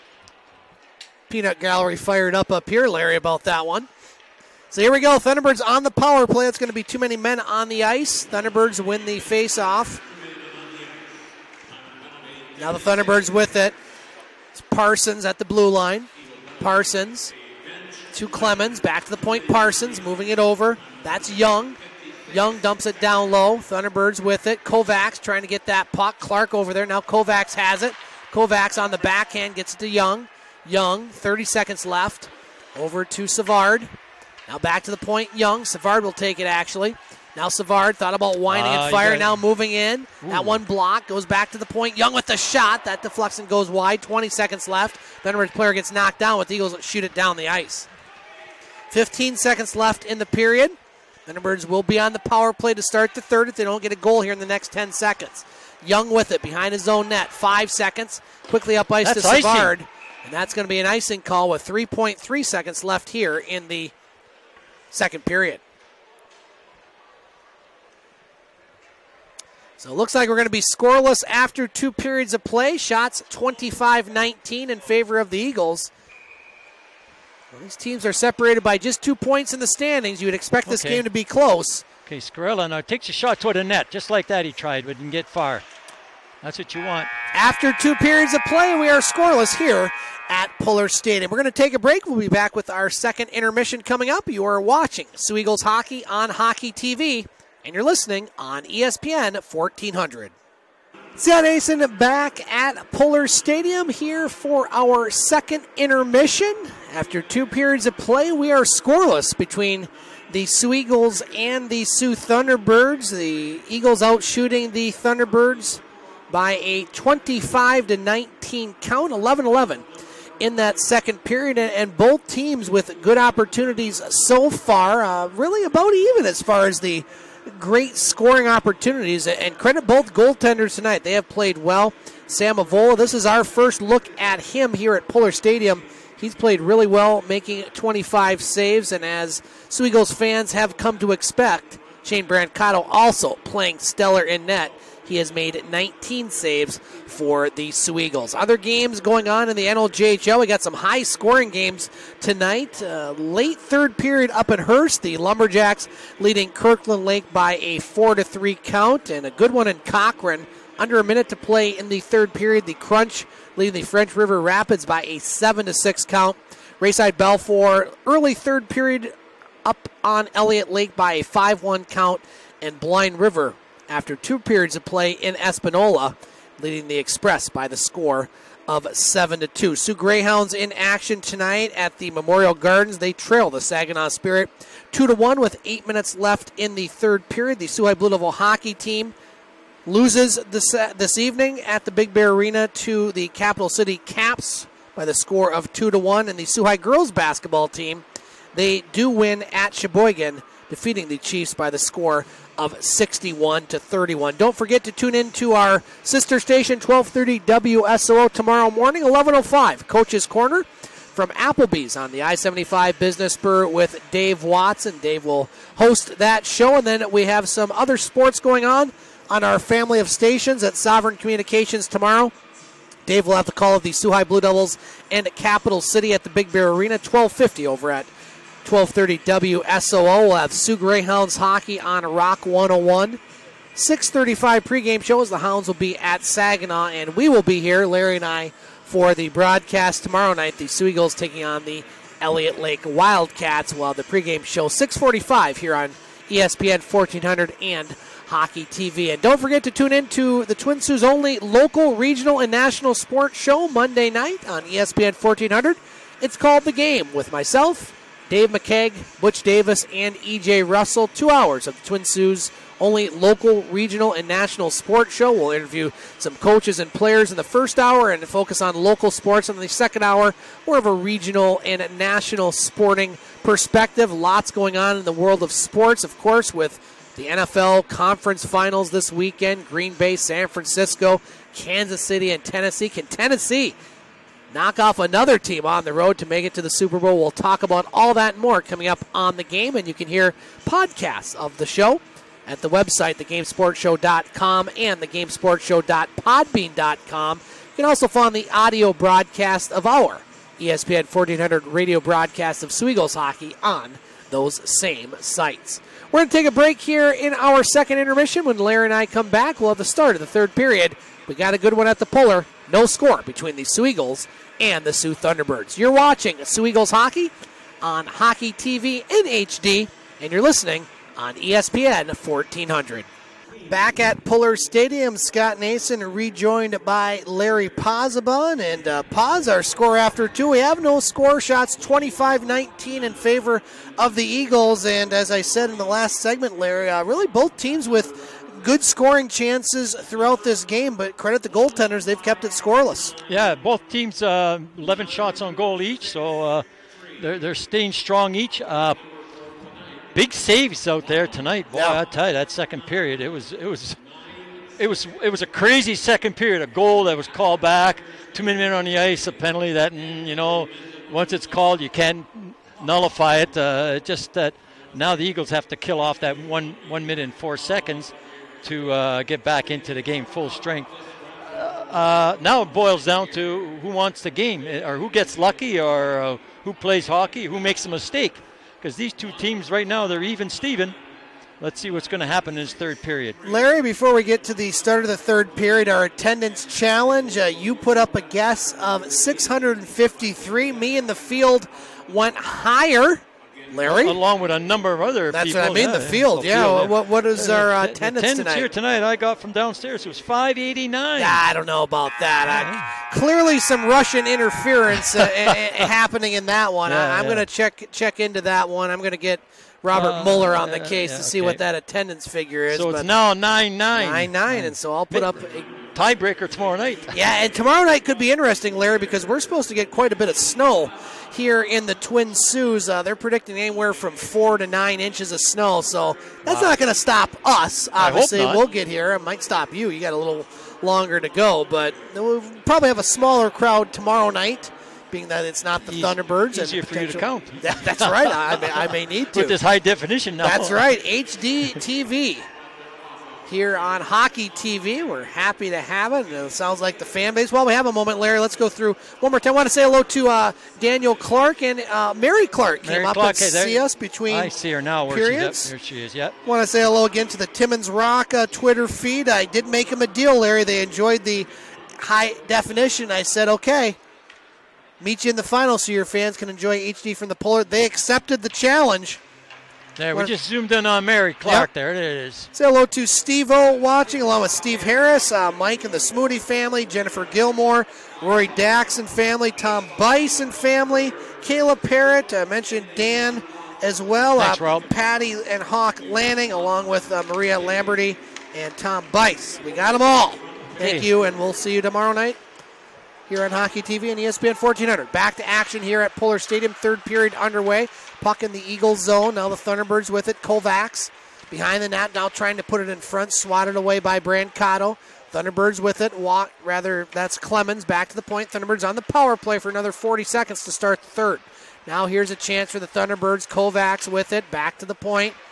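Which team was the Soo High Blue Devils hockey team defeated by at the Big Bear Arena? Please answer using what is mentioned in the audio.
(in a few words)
Capital City Caps.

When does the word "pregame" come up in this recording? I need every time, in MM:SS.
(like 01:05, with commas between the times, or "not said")
03:54, 04:04.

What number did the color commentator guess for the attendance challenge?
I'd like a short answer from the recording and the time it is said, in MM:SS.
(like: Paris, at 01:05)
653, at 06:29.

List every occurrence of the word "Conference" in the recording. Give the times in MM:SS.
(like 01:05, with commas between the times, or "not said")
04:37.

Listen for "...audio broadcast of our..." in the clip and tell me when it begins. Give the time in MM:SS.
04:58.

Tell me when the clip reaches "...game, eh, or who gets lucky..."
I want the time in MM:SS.
06:14.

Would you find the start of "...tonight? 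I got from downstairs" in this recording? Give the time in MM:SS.
06:38.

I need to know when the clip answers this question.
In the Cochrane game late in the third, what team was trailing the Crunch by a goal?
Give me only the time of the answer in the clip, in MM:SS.
02:43.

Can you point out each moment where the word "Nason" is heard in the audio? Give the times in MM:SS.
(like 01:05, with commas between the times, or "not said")
01:41, 05:25.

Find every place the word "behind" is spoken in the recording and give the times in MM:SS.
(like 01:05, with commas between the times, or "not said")
00:56, 08:21.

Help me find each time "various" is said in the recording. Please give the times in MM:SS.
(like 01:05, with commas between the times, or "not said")
not said.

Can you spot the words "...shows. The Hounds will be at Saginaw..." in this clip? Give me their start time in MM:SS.
03:55.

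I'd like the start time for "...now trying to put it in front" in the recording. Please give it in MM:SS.
08:22.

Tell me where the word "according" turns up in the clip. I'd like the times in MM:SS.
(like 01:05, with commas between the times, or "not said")
not said.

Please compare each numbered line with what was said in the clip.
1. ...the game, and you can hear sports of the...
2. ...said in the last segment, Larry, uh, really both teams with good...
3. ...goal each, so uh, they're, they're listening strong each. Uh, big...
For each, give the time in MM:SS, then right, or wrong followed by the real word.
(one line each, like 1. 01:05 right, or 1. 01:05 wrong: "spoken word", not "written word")
1. 04:49 wrong: "podcasts", not "sports"
2. 05:35 right
3. 05:45 wrong: "staying", not "listening".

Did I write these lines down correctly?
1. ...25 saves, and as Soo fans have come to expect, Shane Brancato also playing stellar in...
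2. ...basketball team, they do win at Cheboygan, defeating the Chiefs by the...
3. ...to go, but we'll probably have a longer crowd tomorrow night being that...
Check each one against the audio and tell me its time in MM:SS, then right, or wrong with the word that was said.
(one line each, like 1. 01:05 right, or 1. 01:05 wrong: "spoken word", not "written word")
1. 02:17 right
2. 03:17 right
3. 07:11 wrong: "smaller", not "longer".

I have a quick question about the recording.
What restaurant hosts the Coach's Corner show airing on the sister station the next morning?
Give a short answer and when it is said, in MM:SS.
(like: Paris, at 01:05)
Applebee's, at 03:31.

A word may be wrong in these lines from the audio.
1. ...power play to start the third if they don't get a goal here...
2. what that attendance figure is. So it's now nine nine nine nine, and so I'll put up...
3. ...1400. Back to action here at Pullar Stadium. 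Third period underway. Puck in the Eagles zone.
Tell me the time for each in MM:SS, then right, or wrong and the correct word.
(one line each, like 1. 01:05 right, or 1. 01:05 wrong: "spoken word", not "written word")
1. 00:52 right
2. 06:51 right
3. 08:14 right.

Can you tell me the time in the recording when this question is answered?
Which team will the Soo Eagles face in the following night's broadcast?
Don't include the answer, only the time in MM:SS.
04:02.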